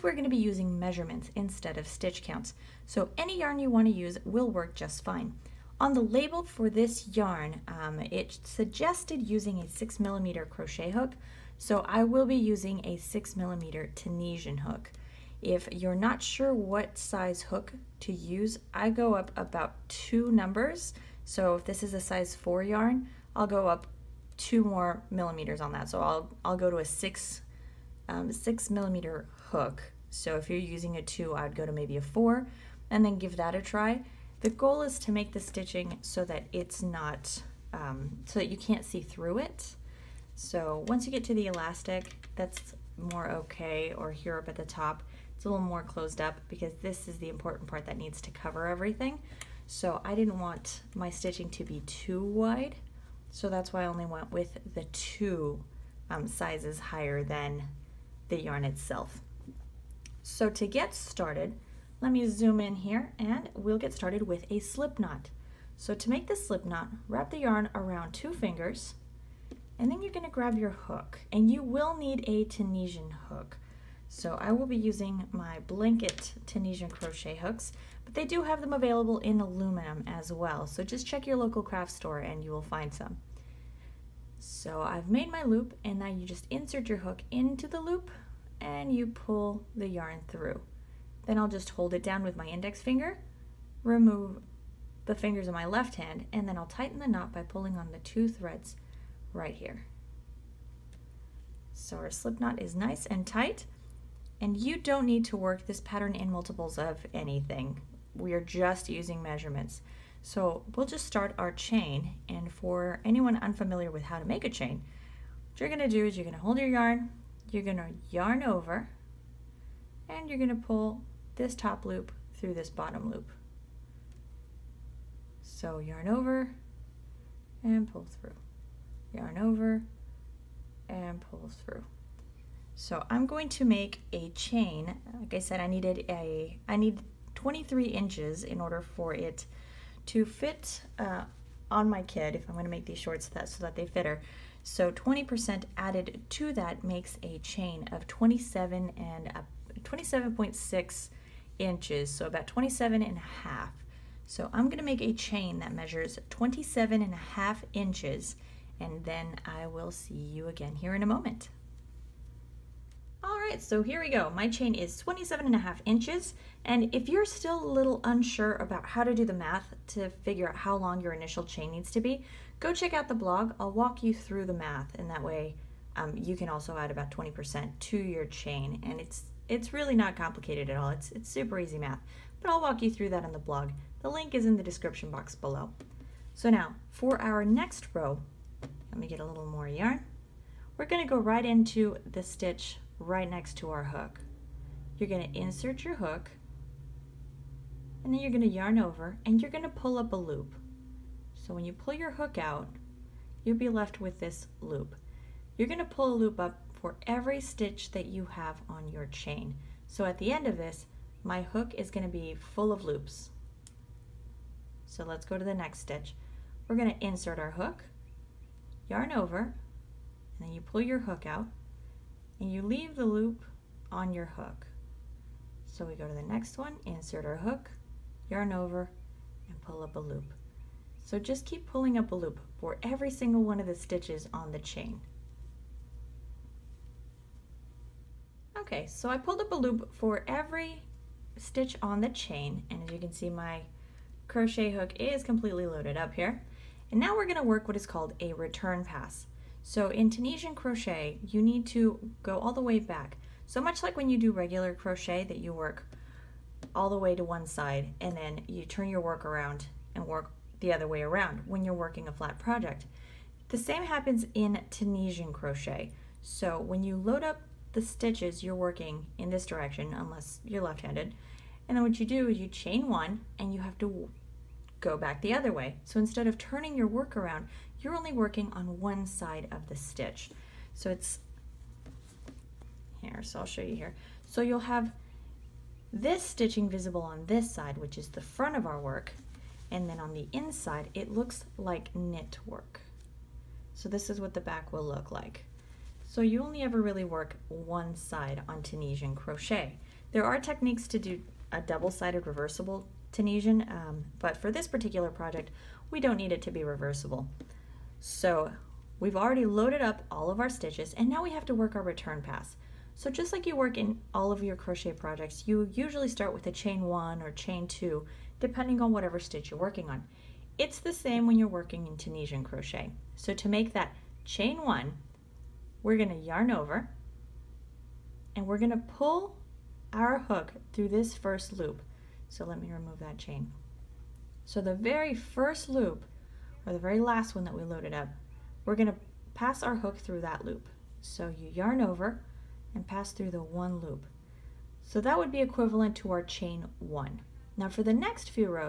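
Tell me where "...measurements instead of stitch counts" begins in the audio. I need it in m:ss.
0:00.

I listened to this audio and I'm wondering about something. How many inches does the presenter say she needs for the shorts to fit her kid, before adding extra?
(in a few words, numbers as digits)
23 inches.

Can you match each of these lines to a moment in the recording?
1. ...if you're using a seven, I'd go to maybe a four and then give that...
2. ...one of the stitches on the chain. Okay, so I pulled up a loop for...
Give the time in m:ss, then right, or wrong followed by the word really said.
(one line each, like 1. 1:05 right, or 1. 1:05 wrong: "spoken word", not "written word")
1. 0:30 wrong: "two", not "seven"
2. 3:53 right.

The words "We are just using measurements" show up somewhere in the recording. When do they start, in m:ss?
1:48.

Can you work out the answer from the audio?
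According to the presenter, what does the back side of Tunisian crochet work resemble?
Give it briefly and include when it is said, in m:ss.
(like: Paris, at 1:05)
knit work, at 4:51.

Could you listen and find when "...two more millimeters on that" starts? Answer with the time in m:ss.
0:24.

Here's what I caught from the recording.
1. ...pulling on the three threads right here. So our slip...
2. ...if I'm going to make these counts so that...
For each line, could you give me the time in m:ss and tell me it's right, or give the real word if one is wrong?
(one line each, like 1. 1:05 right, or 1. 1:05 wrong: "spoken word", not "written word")
1. 1:37 wrong: "two", not "three"
2. 2:22 wrong: "shorts", not "counts".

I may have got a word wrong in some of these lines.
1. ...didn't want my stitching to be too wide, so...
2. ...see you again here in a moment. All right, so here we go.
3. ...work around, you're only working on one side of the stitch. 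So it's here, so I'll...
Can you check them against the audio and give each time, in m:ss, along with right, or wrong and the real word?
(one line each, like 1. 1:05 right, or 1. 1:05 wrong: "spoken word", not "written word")
1. 0:50 right
2. 2:39 right
3. 4:36 right.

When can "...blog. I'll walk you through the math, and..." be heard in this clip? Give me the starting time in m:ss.
2:53.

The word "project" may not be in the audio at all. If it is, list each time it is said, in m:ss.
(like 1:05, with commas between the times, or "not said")
4:22, 5:05, 5:14.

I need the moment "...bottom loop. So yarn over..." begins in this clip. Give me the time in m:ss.
2:02.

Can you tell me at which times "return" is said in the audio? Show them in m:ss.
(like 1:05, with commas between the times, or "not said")
4:08, 5:11.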